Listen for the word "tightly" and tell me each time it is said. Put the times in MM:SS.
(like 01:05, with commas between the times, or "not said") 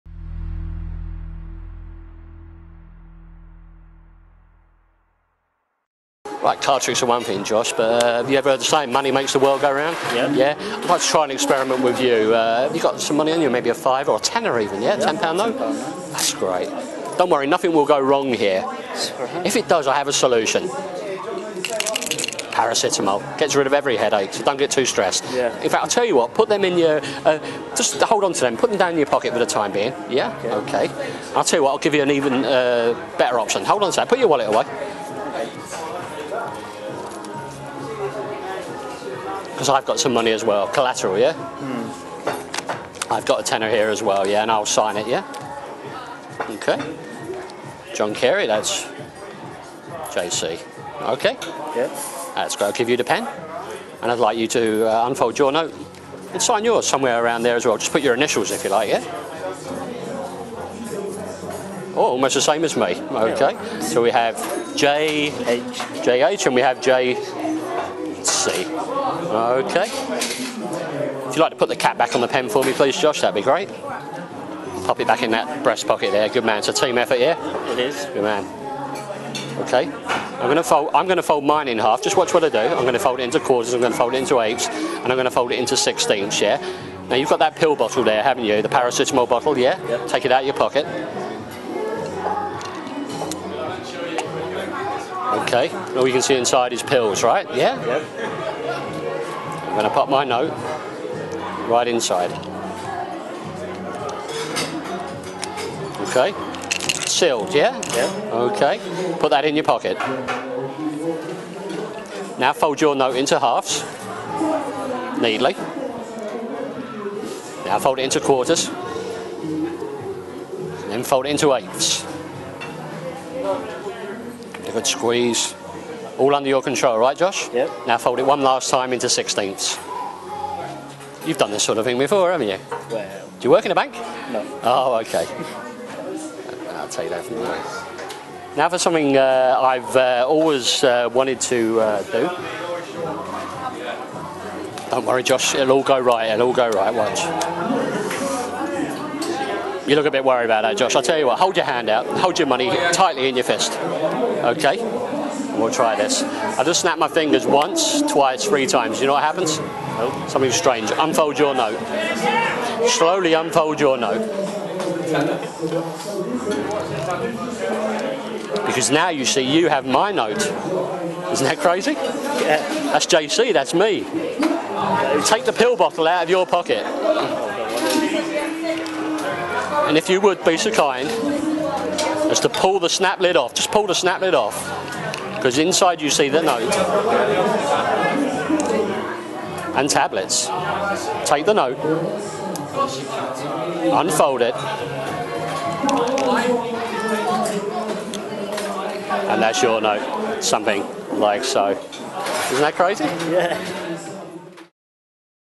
02:32.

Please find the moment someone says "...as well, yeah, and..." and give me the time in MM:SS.
00:43.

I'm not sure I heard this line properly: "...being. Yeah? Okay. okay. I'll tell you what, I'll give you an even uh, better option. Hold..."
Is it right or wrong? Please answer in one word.
right.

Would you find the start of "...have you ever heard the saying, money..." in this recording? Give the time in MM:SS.
00:08.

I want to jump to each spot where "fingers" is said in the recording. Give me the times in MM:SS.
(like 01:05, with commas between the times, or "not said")
02:37.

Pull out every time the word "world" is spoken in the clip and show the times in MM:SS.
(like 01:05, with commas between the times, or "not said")
00:09.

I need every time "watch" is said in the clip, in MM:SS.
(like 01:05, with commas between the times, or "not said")
01:22, 02:26.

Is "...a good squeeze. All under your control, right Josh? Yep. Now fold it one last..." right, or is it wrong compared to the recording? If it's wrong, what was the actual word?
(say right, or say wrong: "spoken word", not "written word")
right.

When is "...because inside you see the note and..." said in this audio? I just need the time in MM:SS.
03:05.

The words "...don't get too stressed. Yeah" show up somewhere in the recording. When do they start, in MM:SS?
00:24.